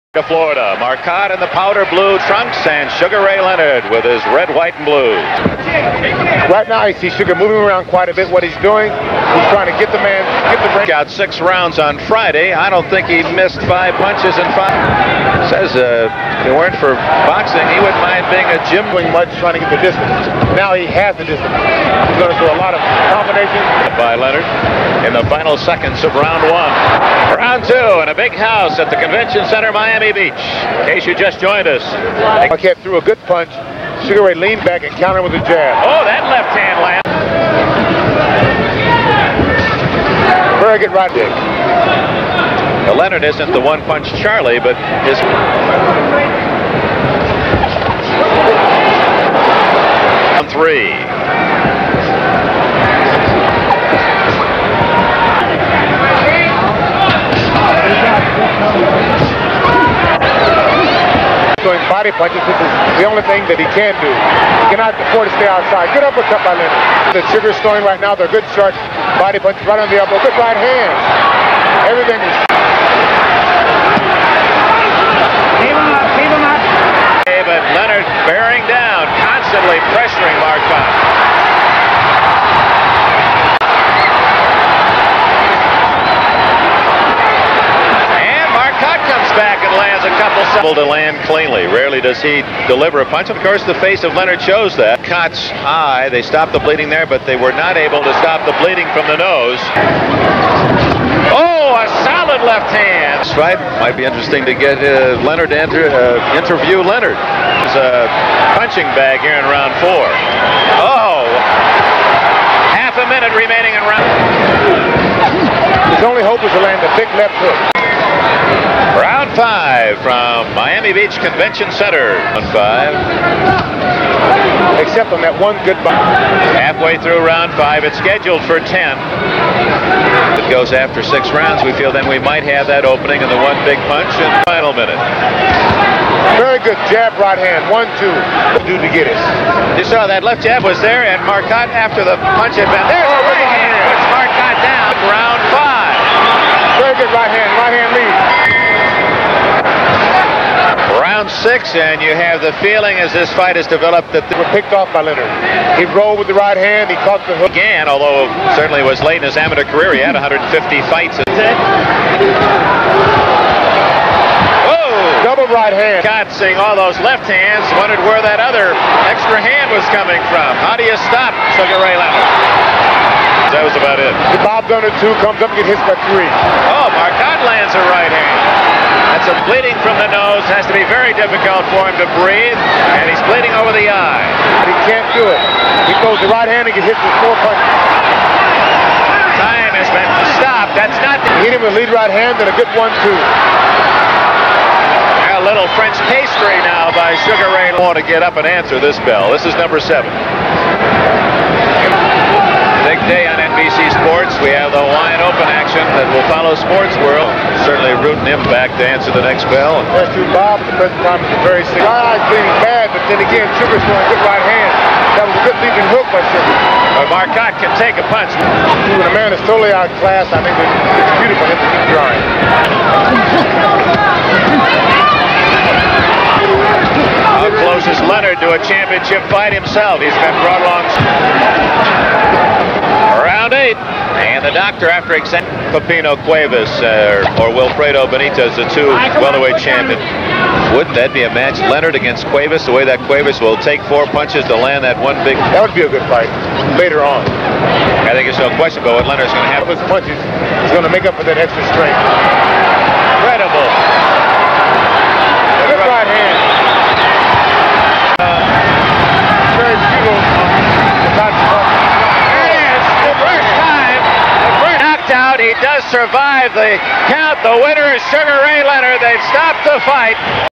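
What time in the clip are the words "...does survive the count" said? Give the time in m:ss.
4:25.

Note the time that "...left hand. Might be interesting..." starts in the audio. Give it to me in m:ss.
1:42.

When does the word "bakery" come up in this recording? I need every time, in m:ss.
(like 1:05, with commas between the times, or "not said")
not said.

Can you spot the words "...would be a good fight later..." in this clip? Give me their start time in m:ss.
4:05.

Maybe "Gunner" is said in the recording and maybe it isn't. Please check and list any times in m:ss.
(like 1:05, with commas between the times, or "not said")
2:54.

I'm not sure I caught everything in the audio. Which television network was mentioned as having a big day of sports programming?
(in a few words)
NBC.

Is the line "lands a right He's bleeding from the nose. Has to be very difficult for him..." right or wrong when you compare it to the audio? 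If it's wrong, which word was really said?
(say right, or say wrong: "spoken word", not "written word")
right.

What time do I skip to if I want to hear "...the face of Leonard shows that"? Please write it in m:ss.
1:33.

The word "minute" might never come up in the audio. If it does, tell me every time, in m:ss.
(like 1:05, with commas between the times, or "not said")
1:53, 2:14.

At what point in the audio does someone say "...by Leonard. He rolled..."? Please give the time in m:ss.
2:34.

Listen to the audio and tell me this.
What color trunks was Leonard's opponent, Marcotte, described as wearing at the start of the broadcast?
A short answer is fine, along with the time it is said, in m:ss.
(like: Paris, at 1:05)
Powder blue, at 0:01.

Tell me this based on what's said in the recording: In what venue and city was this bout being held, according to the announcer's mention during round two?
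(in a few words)
Convention Center, Miami Beach.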